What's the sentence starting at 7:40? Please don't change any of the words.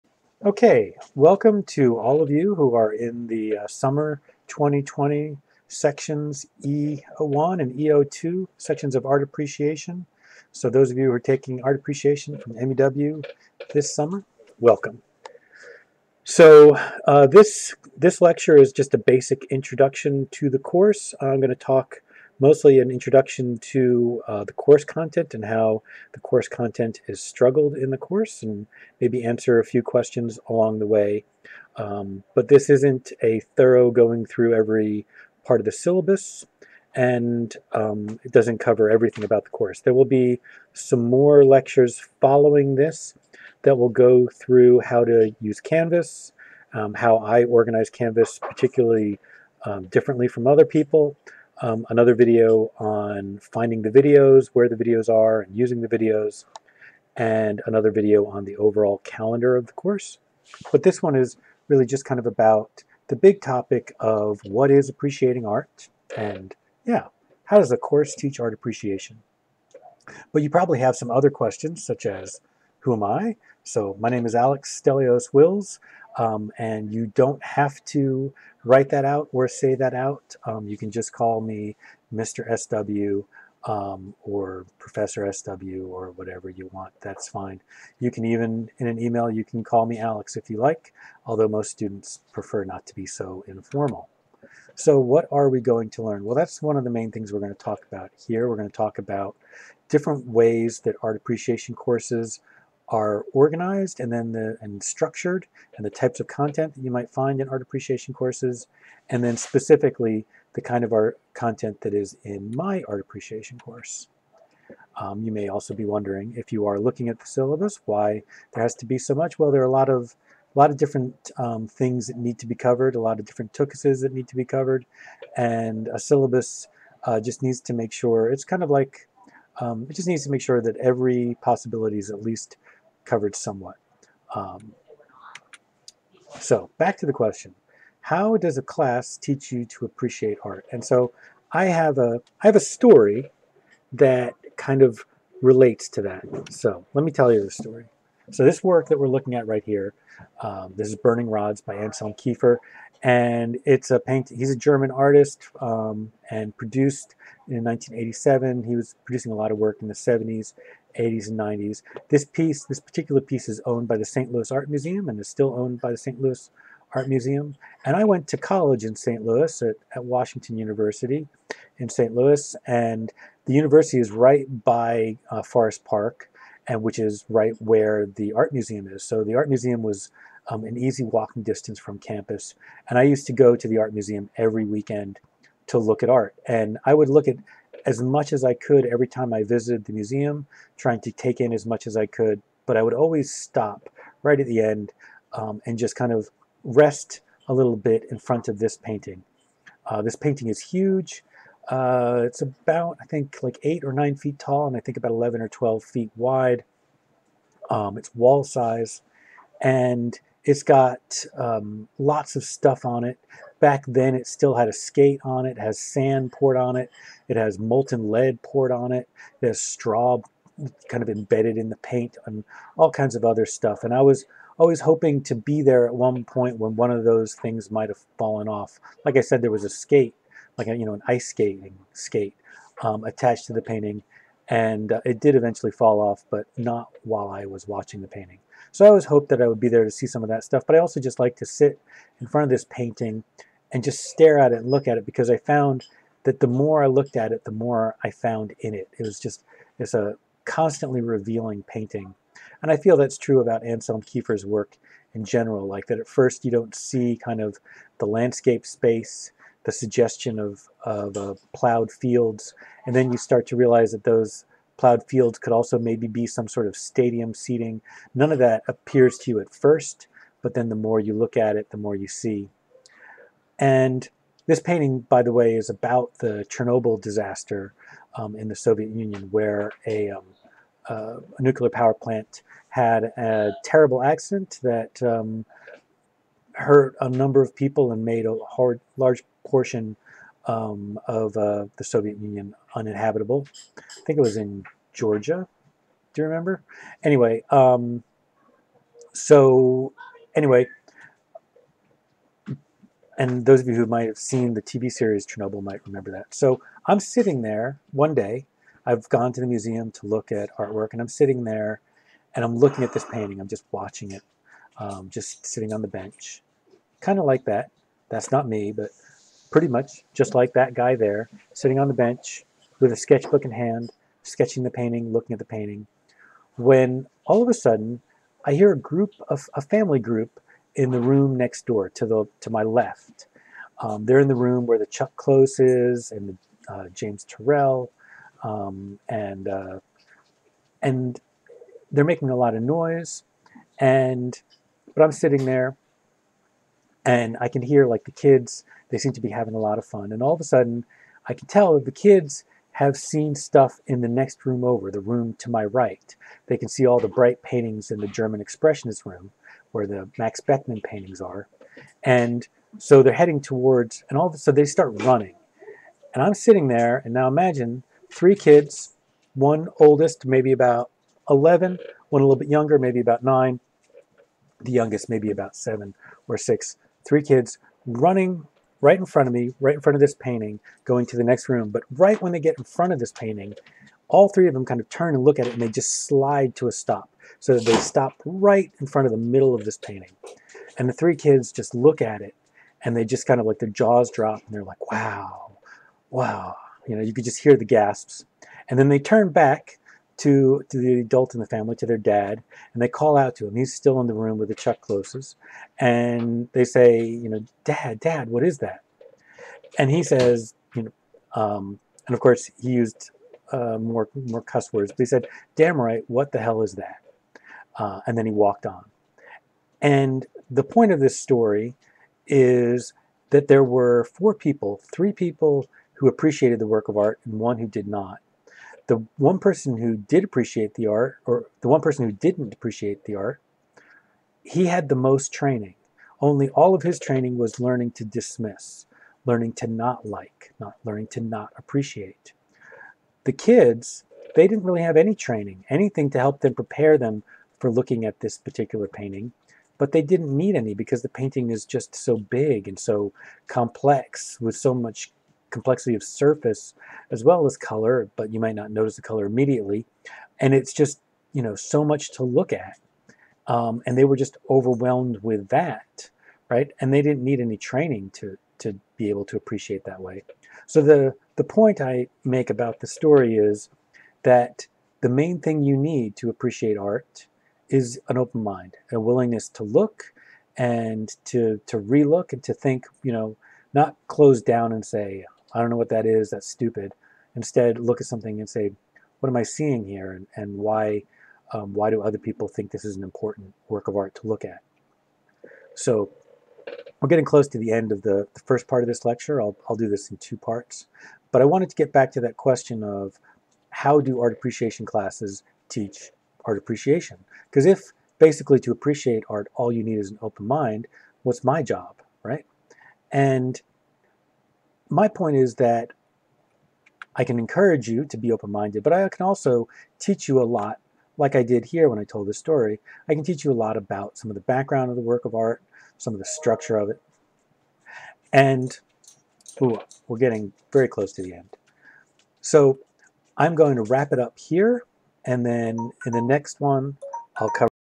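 And it's just, you know, so much to look at.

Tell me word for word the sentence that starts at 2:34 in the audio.
He's a German artist um, and produced in 1987.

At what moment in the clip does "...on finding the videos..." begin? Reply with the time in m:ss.
0:52.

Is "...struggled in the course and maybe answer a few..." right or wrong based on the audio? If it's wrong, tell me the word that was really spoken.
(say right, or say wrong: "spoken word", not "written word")
right.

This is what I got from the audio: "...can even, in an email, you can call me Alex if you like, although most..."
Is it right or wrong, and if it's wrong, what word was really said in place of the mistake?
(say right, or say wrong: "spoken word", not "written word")
right.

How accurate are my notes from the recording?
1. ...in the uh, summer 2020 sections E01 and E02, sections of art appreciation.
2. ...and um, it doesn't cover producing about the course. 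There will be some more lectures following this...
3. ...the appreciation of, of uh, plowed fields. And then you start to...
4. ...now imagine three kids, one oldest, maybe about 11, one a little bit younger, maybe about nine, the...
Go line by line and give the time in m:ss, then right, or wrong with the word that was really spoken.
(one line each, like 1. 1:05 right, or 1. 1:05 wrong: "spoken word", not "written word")
1. 0:02 right
2. 0:36 wrong: "everything", not "producing"
3. 4:19 wrong: "suggestion", not "appreciation"
4. 6:07 right.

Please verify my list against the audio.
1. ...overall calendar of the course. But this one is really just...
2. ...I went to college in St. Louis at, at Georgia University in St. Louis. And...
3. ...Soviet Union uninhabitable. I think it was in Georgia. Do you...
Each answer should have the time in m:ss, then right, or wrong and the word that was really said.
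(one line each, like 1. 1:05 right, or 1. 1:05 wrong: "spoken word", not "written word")
1. 0:58 right
2. 2:47 wrong: "Washington", not "Georgia"
3. 4:51 right.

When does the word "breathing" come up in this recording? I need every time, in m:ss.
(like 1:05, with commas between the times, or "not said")
not said.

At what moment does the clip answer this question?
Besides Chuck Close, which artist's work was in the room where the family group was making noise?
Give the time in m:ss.
5:36.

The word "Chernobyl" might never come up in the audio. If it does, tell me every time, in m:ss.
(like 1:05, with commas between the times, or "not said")
4:36, 5:05.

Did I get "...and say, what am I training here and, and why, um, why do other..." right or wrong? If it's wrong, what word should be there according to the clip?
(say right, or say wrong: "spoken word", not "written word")
wrong: "seeing", not "training".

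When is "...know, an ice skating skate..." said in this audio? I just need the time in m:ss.
3:50.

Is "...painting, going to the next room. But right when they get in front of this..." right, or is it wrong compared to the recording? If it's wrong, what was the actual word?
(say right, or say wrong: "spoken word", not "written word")
right.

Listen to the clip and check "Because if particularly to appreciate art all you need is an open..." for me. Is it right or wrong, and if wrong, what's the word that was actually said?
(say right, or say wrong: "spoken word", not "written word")
wrong: "basically", not "particularly".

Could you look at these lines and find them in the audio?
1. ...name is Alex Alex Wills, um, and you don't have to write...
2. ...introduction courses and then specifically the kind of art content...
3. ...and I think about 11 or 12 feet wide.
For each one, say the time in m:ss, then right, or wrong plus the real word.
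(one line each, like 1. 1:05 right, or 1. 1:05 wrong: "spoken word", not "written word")
1. 1:14 wrong: "Stelios", not "Alex"
2. 1:47 wrong: "appreciation", not "introduction"
3. 3:24 right.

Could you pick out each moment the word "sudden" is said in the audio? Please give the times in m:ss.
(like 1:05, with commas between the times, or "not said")
5:27, 5:50, 6:04.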